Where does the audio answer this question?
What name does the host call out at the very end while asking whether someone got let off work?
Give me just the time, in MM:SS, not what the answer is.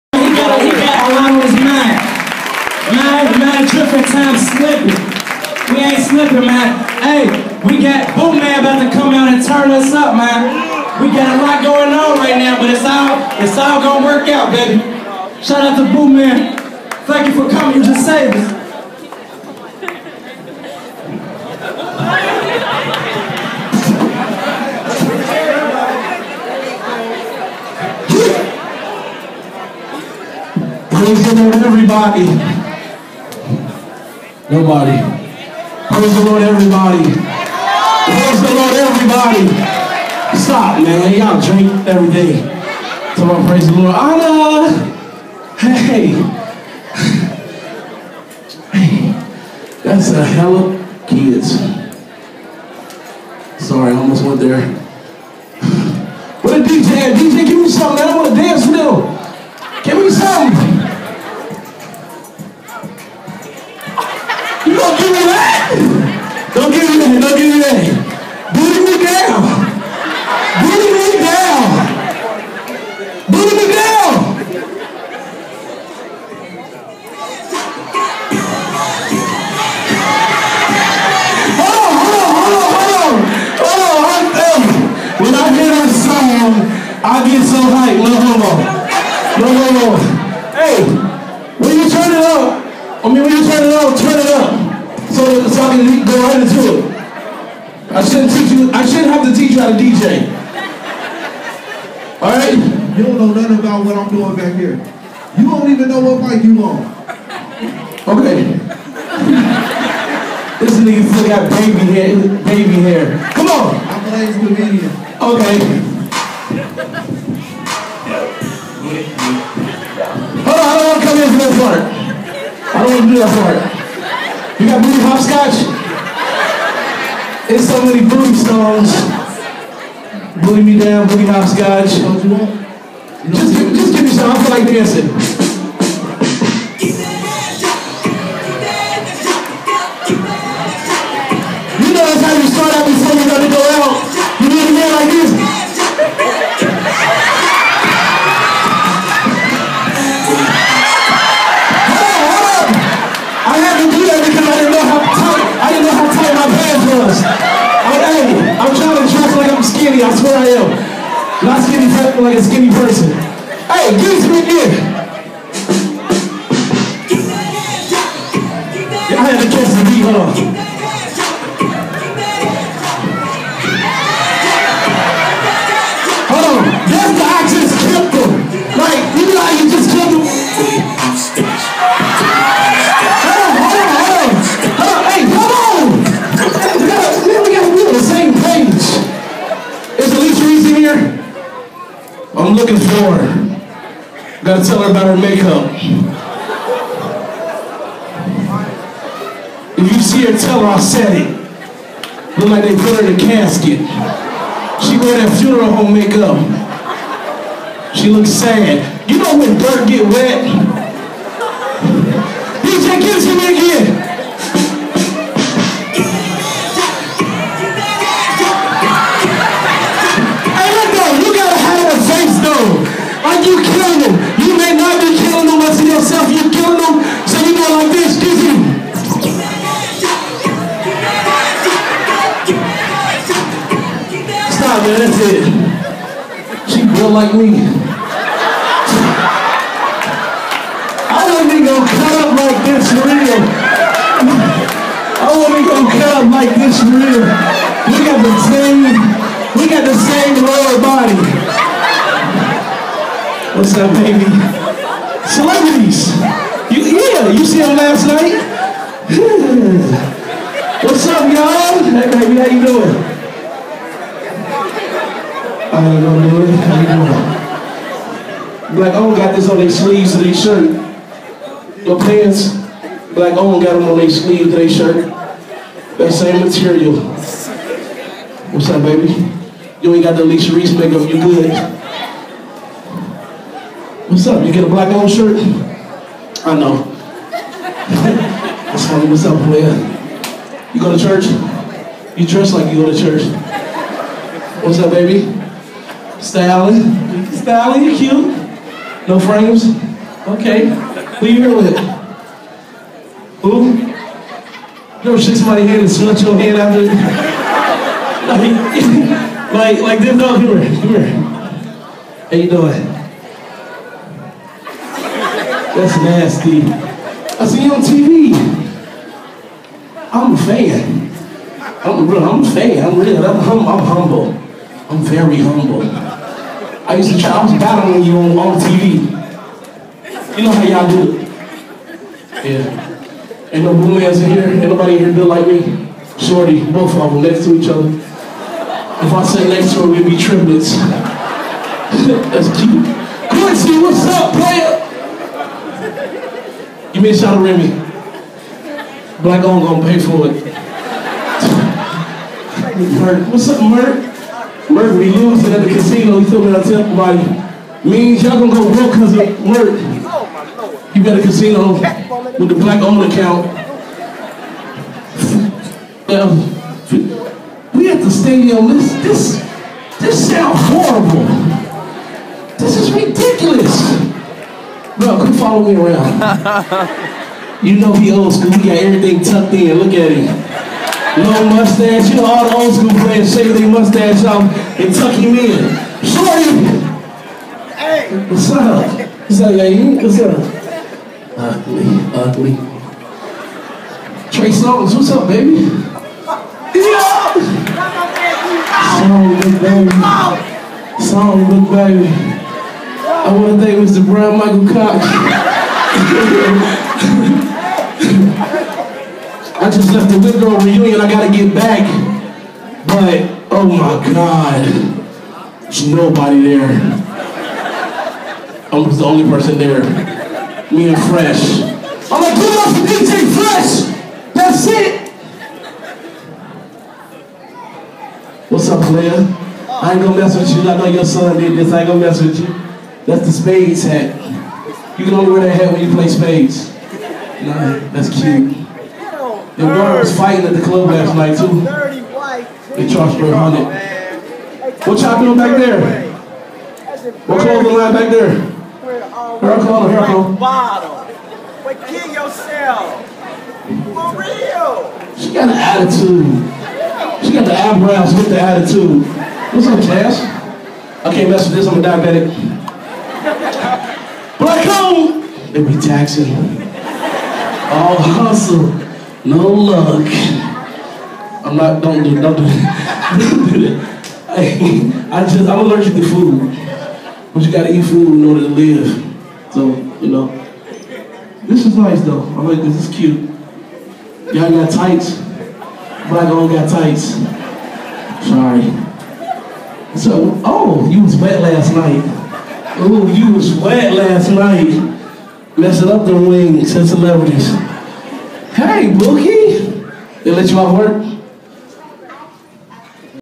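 08:18.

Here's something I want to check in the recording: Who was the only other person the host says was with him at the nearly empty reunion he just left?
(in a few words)
DJ Fresh.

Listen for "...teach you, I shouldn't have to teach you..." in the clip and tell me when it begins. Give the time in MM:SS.
01:38.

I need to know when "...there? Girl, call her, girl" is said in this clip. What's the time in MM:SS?
07:28.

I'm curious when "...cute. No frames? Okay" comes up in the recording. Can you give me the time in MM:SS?
04:57.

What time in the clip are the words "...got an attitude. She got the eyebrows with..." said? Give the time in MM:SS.
07:35.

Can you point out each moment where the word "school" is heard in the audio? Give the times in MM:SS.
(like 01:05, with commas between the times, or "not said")
06:18, 06:22.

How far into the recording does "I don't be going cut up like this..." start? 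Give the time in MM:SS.
04:01.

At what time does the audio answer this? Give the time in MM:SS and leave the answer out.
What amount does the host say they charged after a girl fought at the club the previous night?
07:23.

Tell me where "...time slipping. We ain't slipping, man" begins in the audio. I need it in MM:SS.
00:03.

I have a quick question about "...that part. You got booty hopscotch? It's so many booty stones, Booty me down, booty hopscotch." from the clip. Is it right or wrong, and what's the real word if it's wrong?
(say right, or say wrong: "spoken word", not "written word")
right.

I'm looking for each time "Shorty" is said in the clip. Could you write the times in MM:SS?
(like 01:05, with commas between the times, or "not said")
05:36, 06:26.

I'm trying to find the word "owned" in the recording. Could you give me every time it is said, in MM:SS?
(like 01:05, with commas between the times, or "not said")
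04:28, 04:33, 06:02.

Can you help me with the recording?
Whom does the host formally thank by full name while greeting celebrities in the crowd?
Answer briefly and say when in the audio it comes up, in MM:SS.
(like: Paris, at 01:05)
Brian Michael Cox, at 06:43.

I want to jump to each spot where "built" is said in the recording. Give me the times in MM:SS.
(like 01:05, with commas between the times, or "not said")
03:56, 05:35.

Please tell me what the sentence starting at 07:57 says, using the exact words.
But you gotta eat food in order to live.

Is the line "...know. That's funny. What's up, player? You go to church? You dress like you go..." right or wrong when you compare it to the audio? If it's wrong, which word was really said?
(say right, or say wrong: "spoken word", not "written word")
right.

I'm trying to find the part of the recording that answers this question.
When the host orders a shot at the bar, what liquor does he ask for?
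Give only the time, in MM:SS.
05:47.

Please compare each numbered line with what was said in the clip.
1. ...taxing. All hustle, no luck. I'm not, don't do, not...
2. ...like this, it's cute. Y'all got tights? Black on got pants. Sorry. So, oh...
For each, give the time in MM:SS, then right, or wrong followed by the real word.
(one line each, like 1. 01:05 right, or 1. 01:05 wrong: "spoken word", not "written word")
1. 07:45 right
2. 08:02 wrong: "tights", not "pants".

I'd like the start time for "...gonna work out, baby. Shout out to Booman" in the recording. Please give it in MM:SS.
00:13.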